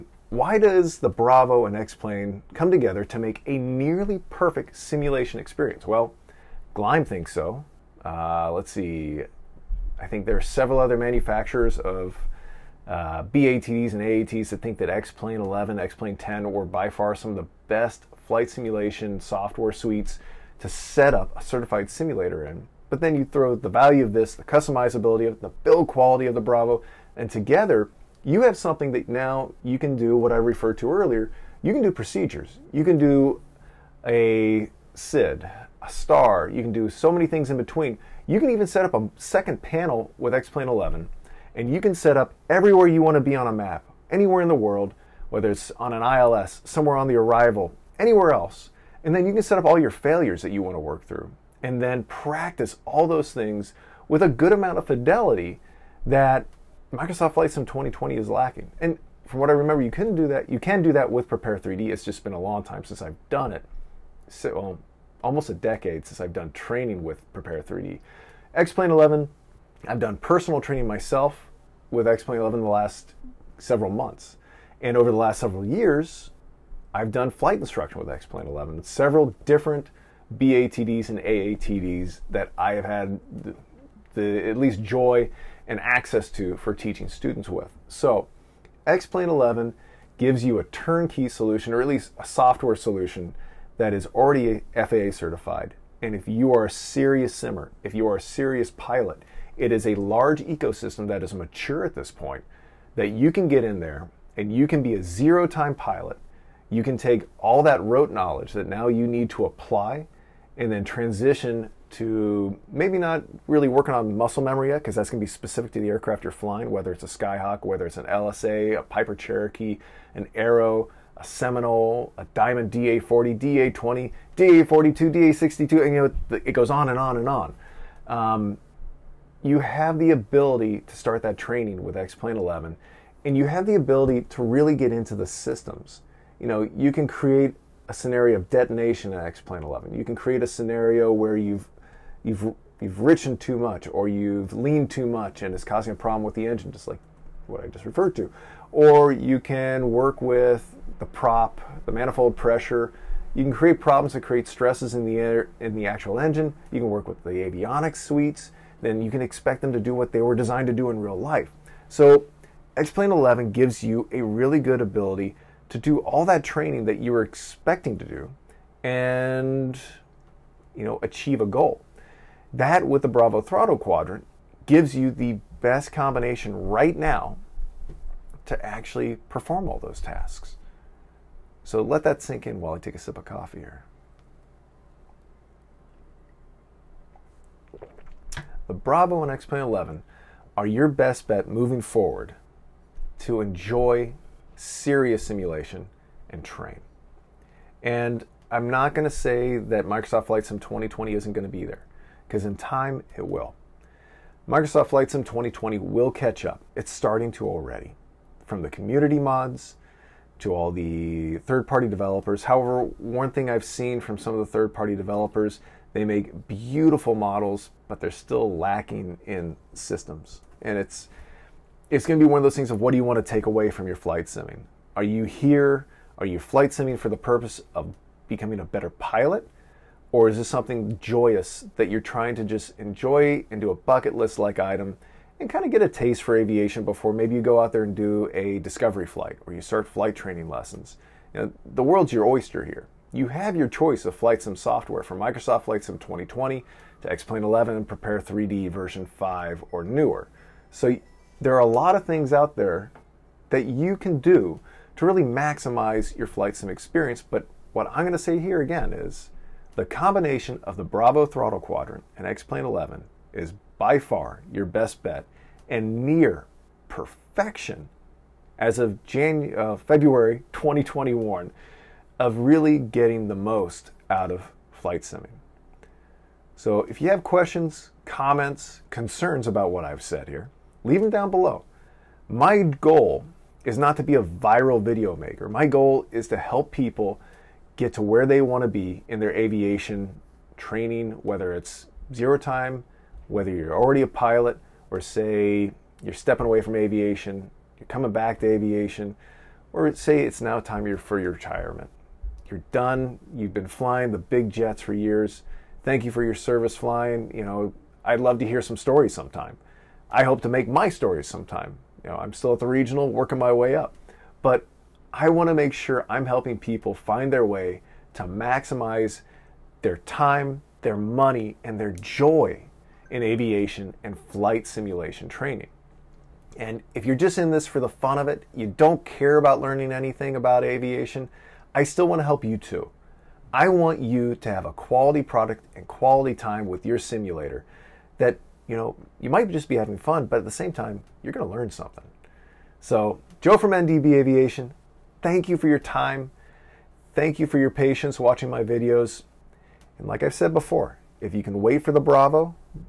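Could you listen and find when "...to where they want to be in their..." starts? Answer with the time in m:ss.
4:47.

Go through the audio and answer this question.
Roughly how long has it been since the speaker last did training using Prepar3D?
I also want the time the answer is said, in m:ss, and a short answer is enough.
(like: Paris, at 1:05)
almost a decade, at 1:05.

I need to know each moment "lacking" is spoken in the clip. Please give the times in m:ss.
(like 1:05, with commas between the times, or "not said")
0:58, 3:38.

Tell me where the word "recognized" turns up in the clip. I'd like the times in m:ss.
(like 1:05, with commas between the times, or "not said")
not said.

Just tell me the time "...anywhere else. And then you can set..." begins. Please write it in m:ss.
0:47.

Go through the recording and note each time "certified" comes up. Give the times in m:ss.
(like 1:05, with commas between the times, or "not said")
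0:21, 1:35.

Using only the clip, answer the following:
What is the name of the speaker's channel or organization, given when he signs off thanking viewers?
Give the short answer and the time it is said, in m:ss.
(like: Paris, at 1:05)
NDB Aviation, at 5:43.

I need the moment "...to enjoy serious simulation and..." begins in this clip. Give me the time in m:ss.
3:13.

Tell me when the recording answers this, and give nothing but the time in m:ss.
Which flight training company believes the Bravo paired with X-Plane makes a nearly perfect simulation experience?
0:06.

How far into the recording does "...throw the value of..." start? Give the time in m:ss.
0:23.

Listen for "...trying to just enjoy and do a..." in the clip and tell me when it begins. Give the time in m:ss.
3:51.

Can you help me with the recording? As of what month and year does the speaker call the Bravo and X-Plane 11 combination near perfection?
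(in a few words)
February 2021.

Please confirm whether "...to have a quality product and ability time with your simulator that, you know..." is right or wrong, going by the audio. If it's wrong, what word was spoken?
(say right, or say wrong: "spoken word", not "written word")
wrong: "quality", not "ability".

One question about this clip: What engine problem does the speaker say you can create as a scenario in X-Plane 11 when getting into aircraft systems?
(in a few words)
detonation.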